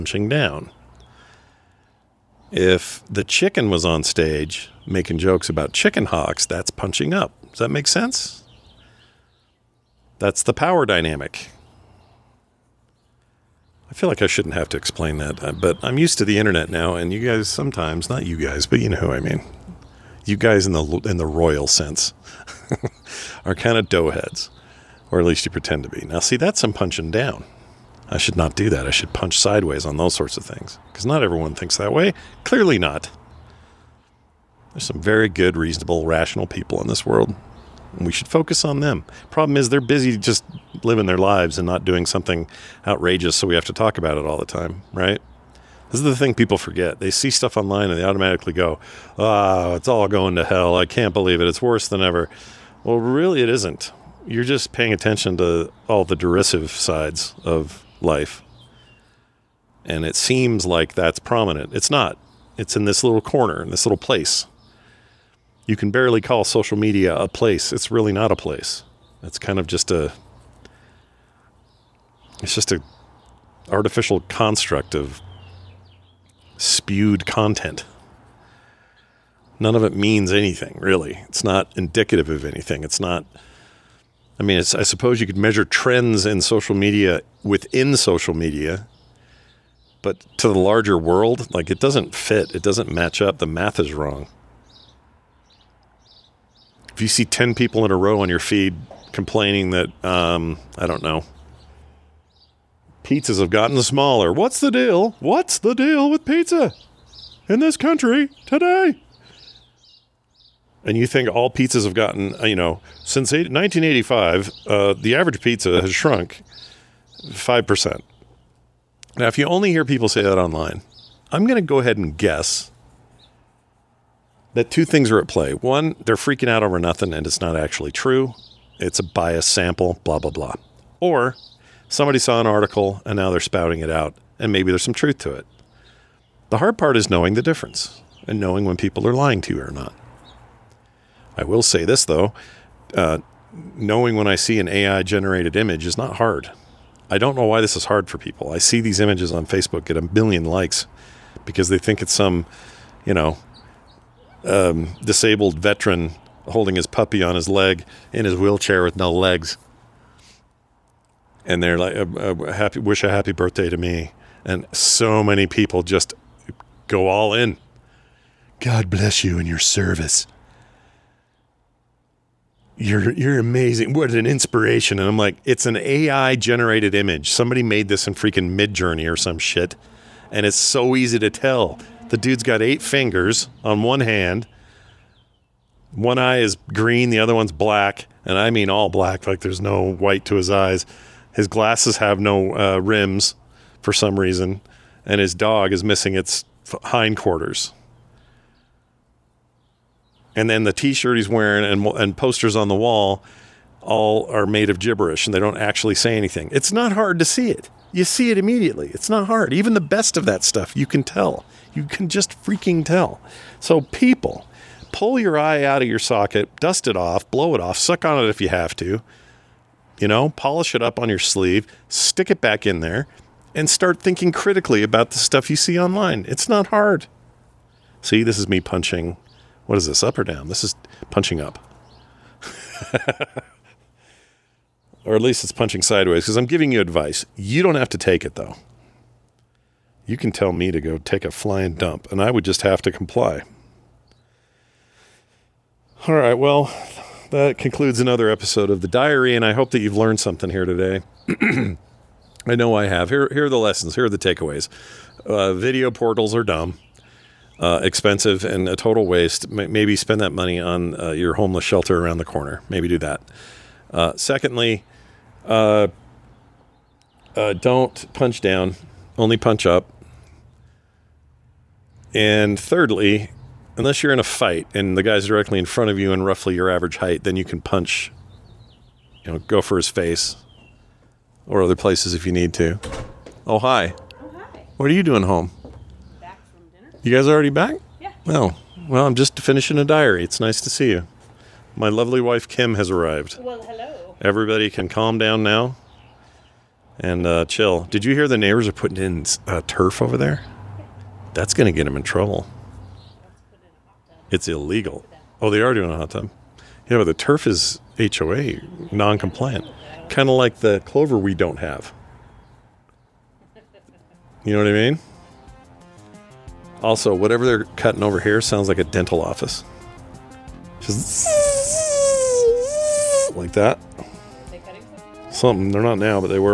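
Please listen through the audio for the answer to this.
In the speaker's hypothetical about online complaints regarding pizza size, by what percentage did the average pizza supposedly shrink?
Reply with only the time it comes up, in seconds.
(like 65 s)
117 s.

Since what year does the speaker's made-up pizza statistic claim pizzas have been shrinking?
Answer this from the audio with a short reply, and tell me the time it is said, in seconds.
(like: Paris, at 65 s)
1985, at 113 s.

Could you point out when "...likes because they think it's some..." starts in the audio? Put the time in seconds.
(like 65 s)
150 s.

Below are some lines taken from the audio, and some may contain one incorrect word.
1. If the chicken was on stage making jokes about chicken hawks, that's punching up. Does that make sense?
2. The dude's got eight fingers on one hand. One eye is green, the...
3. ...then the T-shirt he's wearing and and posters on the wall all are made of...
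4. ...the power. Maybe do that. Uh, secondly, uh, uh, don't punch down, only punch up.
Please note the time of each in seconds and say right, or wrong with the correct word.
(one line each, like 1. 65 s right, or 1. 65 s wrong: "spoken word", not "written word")
1. 2 s right
2. 182 s right
3. 200 s right
4. 262 s wrong: "corner", not "power".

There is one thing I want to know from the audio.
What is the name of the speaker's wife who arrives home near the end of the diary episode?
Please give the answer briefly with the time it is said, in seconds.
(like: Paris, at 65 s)
Kim, at 292 s.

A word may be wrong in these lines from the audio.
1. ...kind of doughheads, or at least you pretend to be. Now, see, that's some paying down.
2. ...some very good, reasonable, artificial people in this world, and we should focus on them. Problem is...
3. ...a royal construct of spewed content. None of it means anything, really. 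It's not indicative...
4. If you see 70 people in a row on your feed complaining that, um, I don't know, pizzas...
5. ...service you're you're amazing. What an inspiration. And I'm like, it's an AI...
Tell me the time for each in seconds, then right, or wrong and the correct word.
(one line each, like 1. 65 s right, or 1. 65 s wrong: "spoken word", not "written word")
1. 23 s wrong: "punching", not "paying"
2. 34 s wrong: "rational", not "artificial"
3. 72 s wrong: "artificial", not "royal"
4. 96 s wrong: "10", not "70"
5. 169 s right.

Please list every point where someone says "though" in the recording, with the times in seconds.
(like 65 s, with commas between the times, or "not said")
142 s, 238 s.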